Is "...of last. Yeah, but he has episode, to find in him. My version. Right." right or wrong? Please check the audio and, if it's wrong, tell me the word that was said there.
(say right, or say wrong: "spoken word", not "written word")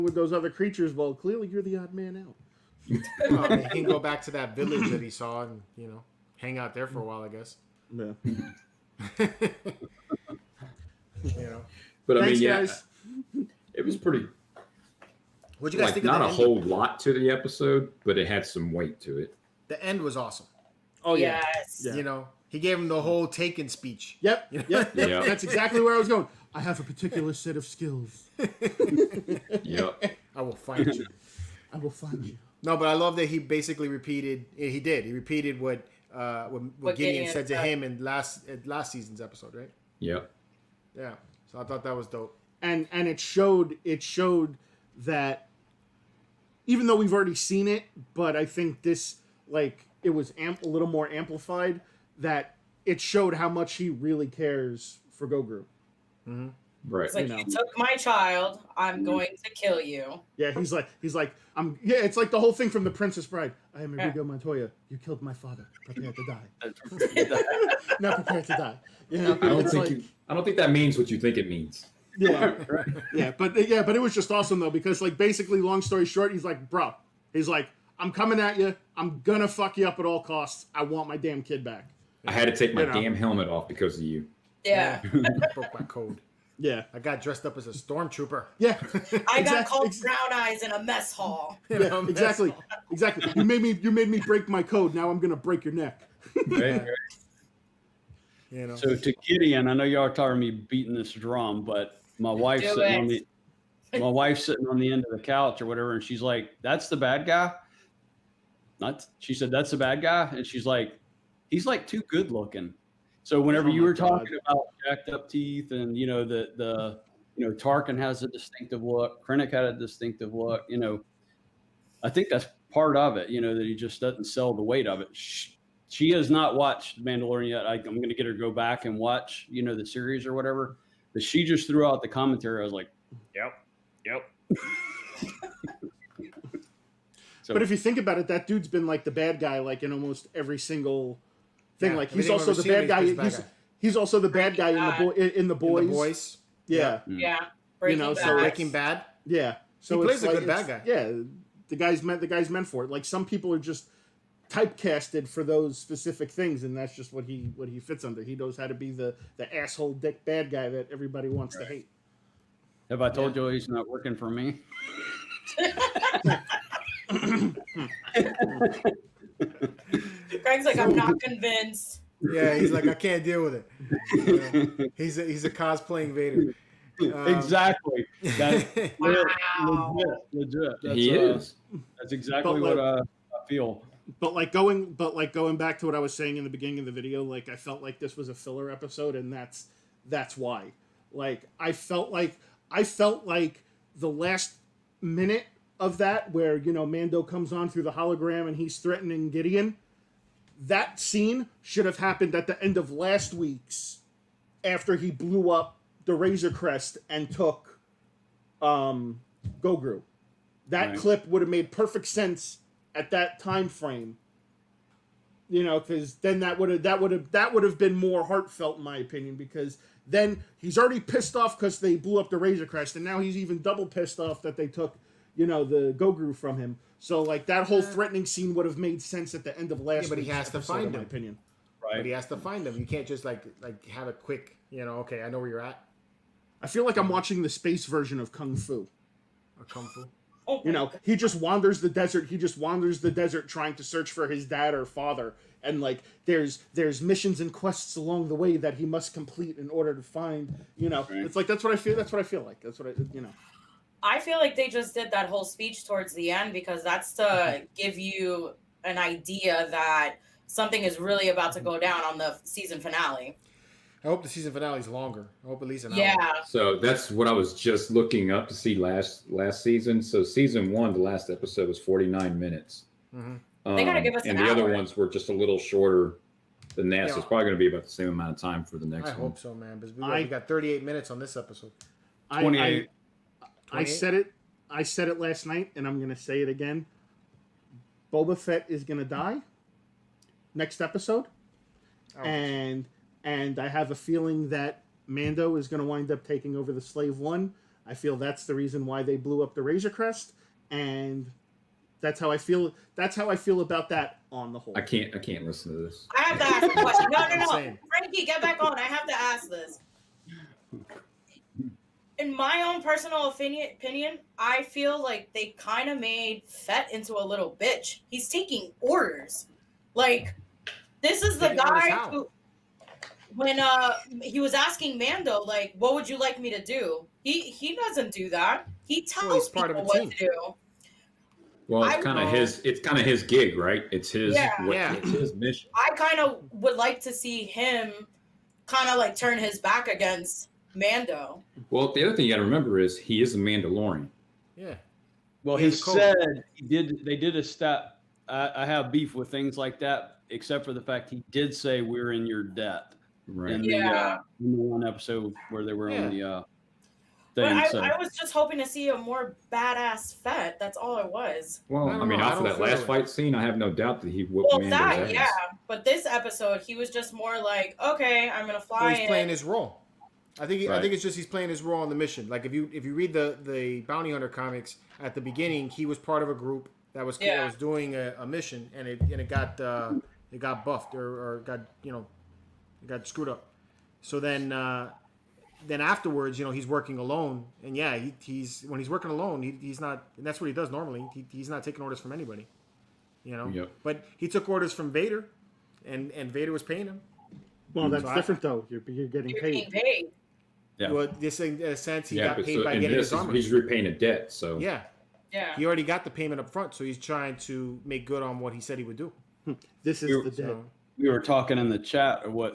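wrong: "opinion", not "version".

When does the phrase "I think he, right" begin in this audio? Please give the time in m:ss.
6:10.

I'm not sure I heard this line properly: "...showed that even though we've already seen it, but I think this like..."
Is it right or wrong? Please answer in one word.
right.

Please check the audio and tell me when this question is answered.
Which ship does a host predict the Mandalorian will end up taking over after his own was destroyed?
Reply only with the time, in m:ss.
4:56.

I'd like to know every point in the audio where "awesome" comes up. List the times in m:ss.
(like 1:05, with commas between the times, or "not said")
0:20, 1:14.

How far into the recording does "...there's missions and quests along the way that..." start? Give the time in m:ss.
4:06.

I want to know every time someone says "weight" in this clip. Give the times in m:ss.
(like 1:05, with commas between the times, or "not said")
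0:18, 2:04.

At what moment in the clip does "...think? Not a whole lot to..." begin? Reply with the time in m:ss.
0:15.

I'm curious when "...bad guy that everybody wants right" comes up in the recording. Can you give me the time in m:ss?
2:40.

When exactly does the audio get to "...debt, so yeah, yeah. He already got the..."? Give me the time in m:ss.
6:43.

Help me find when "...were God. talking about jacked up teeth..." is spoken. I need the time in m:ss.
1:53.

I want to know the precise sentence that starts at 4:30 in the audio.
So season one, the last episode was forty nine minutes.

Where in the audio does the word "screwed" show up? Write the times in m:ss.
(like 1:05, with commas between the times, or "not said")
6:23.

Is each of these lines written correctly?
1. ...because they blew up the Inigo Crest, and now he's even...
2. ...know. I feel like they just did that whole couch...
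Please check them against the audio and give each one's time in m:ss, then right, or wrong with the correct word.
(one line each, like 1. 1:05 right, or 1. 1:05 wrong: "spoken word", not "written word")
1. 3:41 wrong: "Razor", not "Inigo"
2. 4:13 wrong: "speech", not "couch".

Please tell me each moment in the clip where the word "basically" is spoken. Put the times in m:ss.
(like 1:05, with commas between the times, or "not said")
0:33, 1:15.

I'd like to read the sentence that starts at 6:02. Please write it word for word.
fight scene, I have no doubt that he would.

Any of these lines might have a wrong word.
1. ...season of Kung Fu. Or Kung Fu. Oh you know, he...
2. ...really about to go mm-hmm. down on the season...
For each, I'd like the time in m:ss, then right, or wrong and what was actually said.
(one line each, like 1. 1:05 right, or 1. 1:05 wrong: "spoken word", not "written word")
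1. 3:57 wrong: "version", not "season"
2. 4:21 right.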